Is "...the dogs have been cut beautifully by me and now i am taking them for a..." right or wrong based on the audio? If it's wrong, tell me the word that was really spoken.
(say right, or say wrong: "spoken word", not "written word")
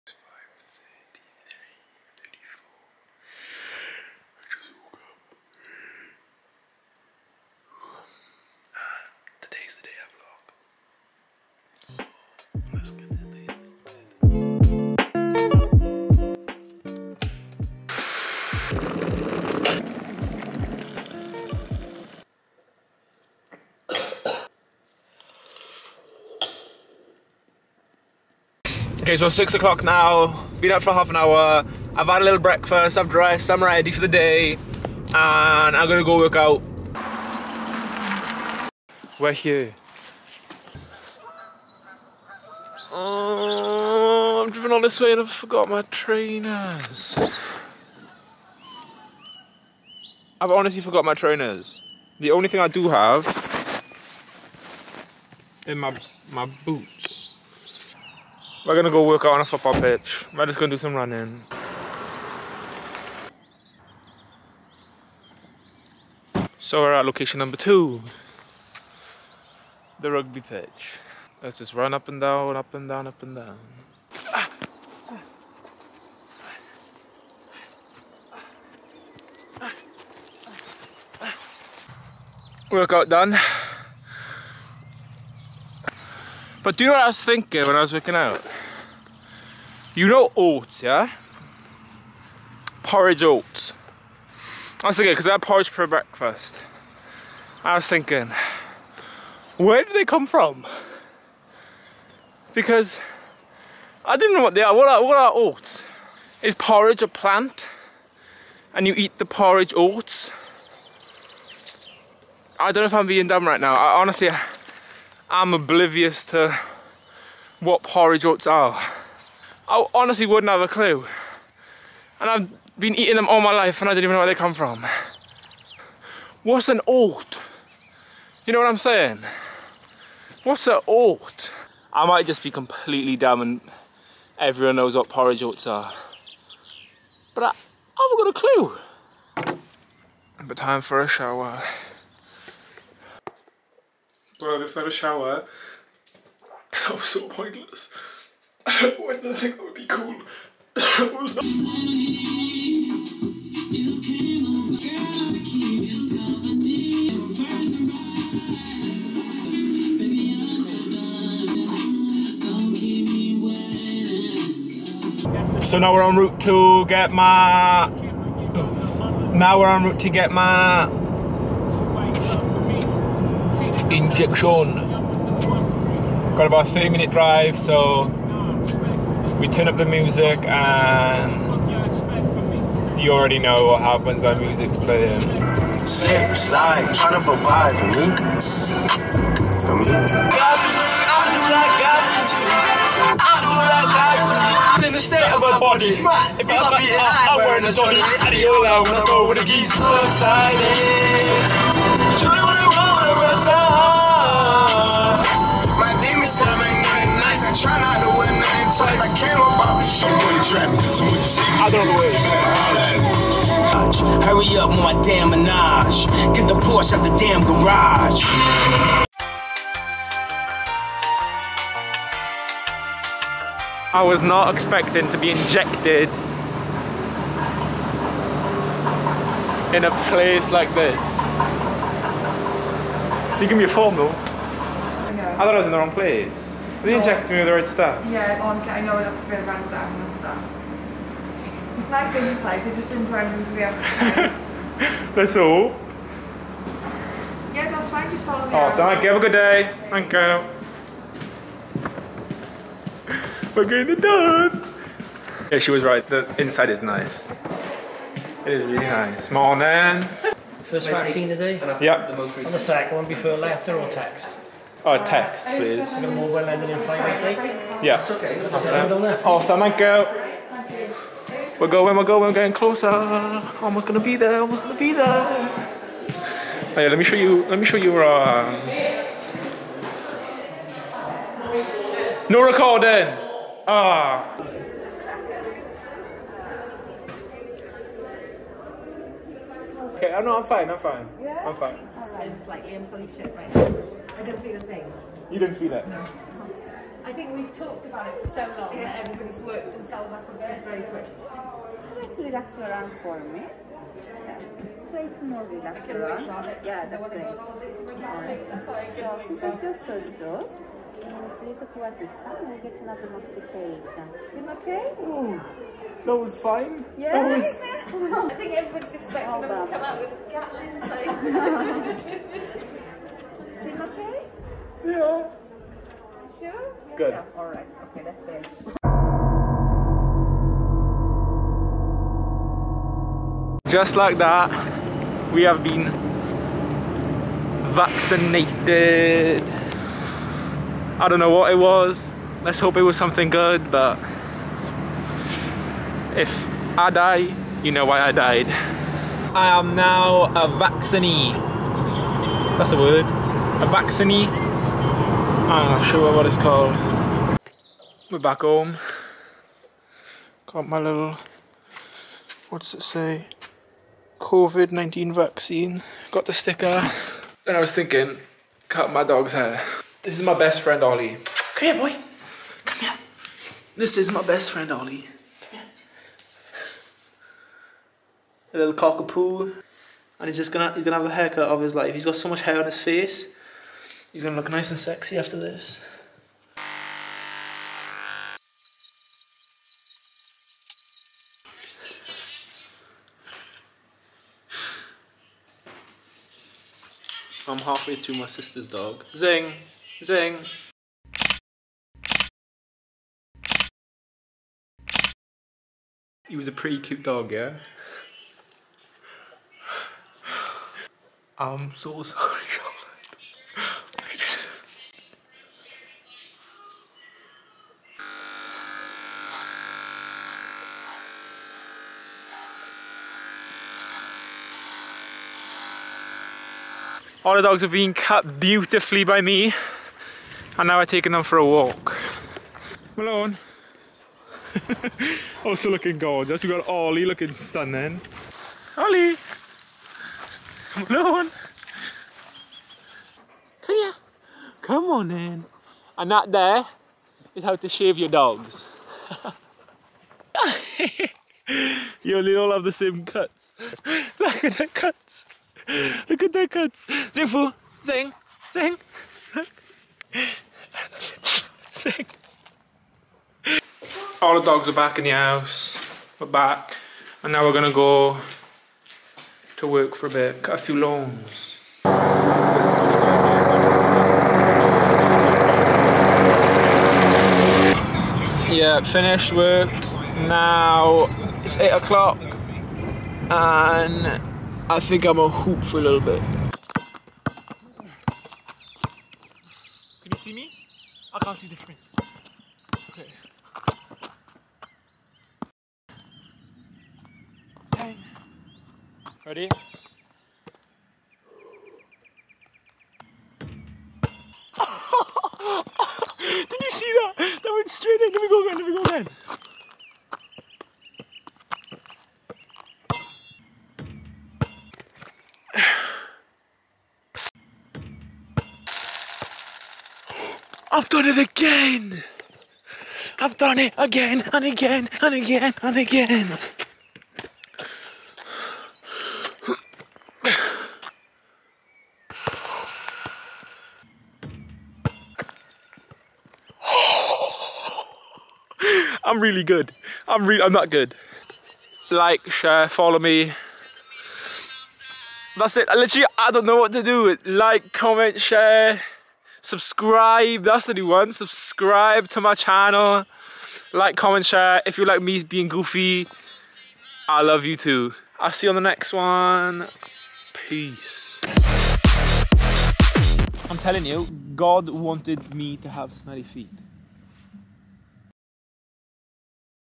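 right.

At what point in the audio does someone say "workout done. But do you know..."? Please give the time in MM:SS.
01:22.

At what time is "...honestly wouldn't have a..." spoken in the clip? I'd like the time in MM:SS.
01:59.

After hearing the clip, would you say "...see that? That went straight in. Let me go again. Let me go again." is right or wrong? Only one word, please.
right.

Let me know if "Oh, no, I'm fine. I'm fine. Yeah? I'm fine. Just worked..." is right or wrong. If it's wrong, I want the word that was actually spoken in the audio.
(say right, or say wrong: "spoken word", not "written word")
wrong: "turned", not "worked".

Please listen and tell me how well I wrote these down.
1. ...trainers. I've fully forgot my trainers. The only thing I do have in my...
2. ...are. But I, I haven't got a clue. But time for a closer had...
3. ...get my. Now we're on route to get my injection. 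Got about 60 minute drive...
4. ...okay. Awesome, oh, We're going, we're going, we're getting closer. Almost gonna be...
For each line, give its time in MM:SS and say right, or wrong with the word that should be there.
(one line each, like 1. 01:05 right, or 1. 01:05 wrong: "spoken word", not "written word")
1. 00:45 wrong: "honestly", not "fully"
2. 02:15 wrong: "shower", not "closer"
3. 02:46 wrong: "30", not "60"
4. 04:28 right.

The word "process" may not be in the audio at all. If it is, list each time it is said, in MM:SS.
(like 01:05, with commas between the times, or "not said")
not said.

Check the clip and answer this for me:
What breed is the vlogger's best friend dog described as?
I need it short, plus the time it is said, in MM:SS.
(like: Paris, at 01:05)
Cockapoo, at 06:18.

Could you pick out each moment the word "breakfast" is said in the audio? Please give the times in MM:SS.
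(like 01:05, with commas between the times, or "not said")
00:32, 01:35.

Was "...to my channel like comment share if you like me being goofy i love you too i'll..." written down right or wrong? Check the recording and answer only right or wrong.
right.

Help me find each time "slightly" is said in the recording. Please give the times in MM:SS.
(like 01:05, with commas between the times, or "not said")
04:52.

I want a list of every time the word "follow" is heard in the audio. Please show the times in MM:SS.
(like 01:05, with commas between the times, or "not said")
04:08, 09:02.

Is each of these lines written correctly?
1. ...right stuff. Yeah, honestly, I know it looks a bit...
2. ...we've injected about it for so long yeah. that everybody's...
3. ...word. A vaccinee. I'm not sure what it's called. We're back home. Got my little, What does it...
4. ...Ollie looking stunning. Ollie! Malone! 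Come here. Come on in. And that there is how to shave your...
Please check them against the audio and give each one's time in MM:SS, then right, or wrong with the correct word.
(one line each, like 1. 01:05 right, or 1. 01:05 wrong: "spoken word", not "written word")
1. 03:57 right
2. 04:57 wrong: "talked", not "injected"
3. 05:52 right
4. 07:16 right.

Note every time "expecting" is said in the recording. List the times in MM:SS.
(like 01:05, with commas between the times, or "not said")
03:44, 05:18.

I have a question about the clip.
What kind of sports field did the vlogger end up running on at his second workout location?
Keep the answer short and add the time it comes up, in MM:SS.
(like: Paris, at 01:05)
Rugby pitch, at 01:09.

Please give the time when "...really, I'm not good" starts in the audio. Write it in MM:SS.
09:00.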